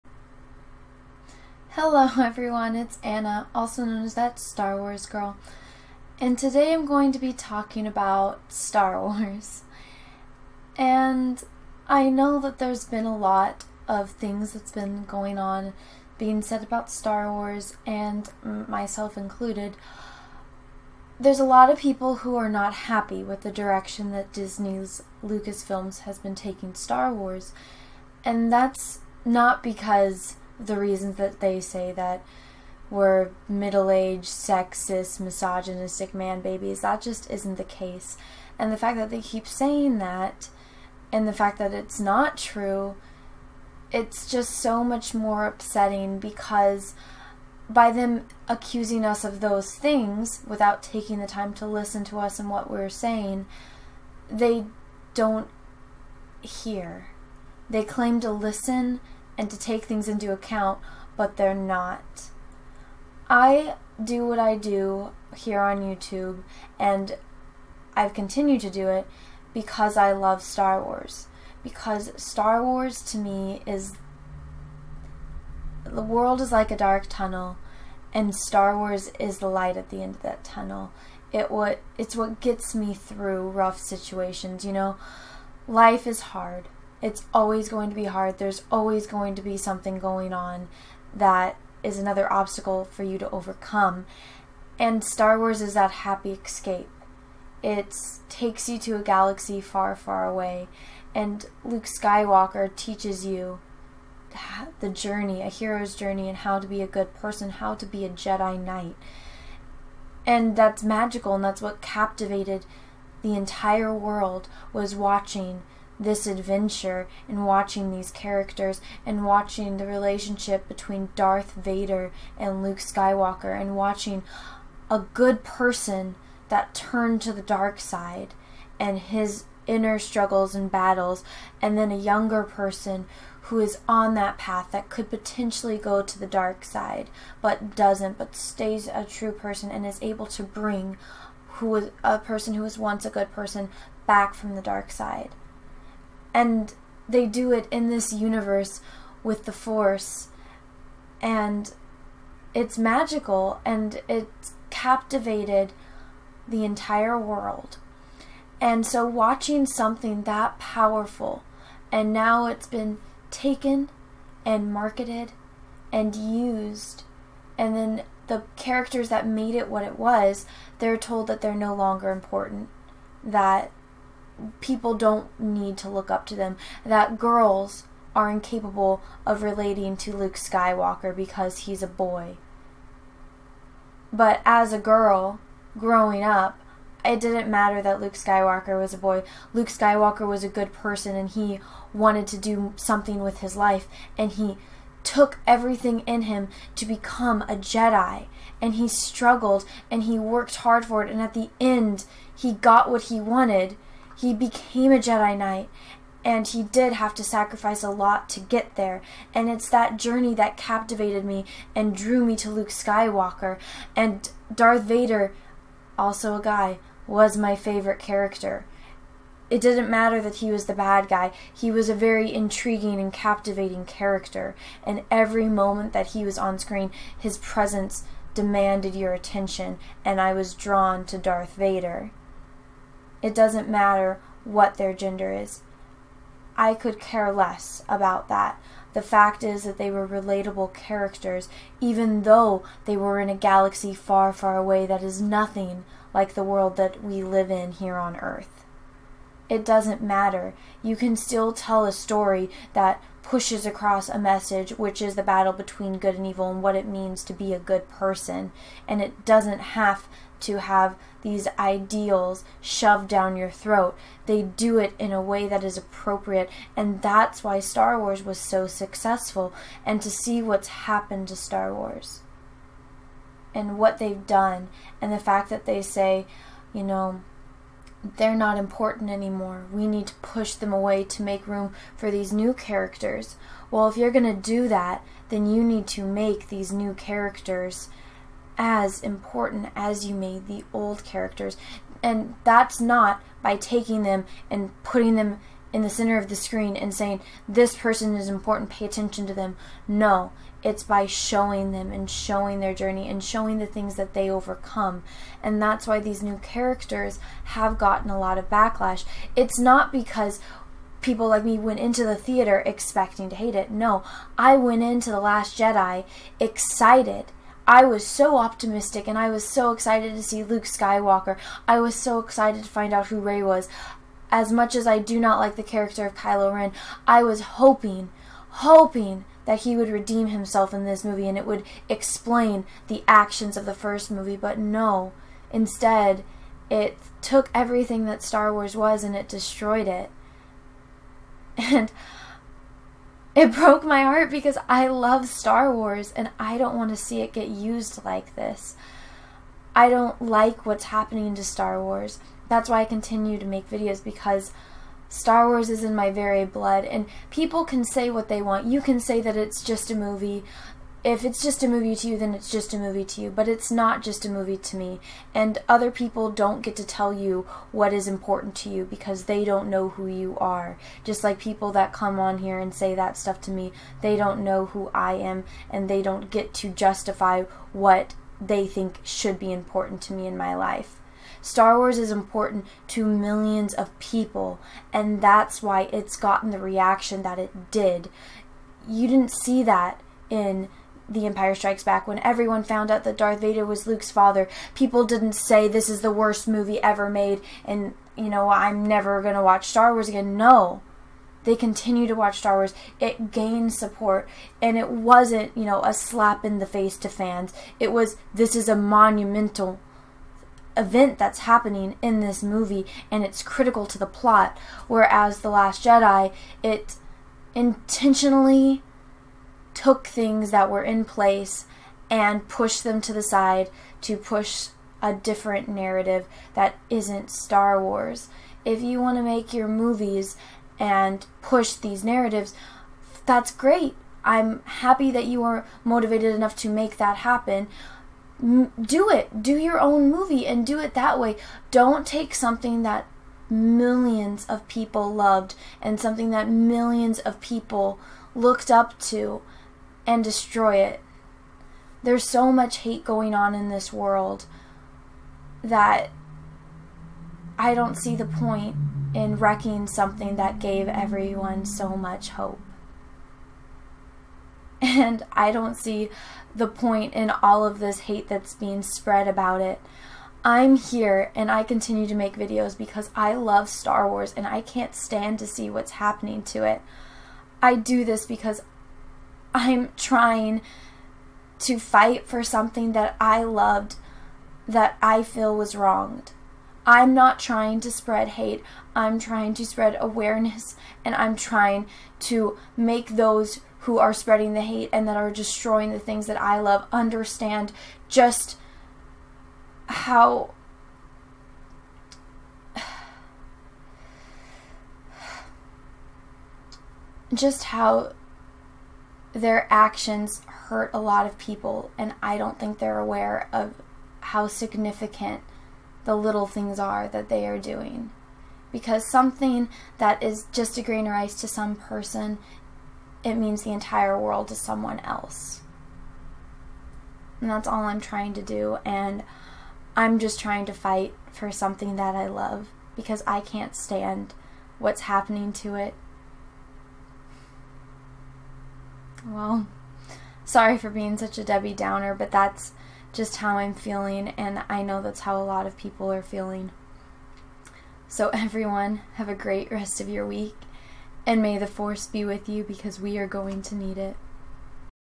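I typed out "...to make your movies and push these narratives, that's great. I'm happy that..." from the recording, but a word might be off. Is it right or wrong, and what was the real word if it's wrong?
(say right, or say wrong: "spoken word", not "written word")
right.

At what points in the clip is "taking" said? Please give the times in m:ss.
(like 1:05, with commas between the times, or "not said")
0:26, 0:50, 4:53.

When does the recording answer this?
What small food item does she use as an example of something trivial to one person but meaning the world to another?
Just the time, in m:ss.
8:40.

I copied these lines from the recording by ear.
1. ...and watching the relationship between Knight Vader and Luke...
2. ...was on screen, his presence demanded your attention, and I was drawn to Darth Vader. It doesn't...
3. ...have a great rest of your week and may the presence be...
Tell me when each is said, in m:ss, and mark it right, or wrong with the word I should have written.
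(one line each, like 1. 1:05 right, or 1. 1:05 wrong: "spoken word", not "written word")
1. 1:59 wrong: "Darth", not "Knight"
2. 3:46 right
3. 9:09 wrong: "force", not "presence".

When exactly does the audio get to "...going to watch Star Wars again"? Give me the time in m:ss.
6:39.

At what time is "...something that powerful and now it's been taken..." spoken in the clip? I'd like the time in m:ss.
2:39.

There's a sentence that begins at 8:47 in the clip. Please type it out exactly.
And that's all I'm trying to do.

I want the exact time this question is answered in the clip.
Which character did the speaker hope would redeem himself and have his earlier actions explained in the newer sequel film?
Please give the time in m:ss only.
5:26.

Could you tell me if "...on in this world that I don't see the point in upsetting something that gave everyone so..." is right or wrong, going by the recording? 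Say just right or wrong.
wrong.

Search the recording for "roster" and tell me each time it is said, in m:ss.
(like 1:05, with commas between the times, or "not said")
not said.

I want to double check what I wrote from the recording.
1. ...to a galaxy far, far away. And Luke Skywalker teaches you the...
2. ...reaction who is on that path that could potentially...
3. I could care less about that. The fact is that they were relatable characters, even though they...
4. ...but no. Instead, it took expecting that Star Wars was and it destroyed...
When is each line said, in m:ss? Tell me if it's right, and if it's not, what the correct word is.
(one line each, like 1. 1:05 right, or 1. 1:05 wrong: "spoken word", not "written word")
1. 1:38 right
2. 2:12 wrong: "person", not "reaction"
3. 3:56 right
4. 5:34 wrong: "everything", not "expecting".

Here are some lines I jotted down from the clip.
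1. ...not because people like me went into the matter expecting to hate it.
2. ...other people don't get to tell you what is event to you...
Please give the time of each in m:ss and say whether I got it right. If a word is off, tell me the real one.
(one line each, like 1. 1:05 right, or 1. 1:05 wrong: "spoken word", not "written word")
1. 5:09 wrong: "theater", not "matter"
2. 6:05 wrong: "important", not "event".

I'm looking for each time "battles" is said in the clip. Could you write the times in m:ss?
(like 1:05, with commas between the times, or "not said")
2:10, 4:15.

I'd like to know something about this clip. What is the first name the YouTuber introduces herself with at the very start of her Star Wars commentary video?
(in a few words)
Anna.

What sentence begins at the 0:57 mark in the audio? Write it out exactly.
They claim to listen and to take things into account, but they're not.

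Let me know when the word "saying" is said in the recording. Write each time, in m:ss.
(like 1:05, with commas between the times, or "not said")
0:39, 0:52, 4:56.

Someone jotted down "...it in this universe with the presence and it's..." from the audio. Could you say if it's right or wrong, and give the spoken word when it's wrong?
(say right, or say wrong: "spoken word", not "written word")
wrong: "force", not "presence".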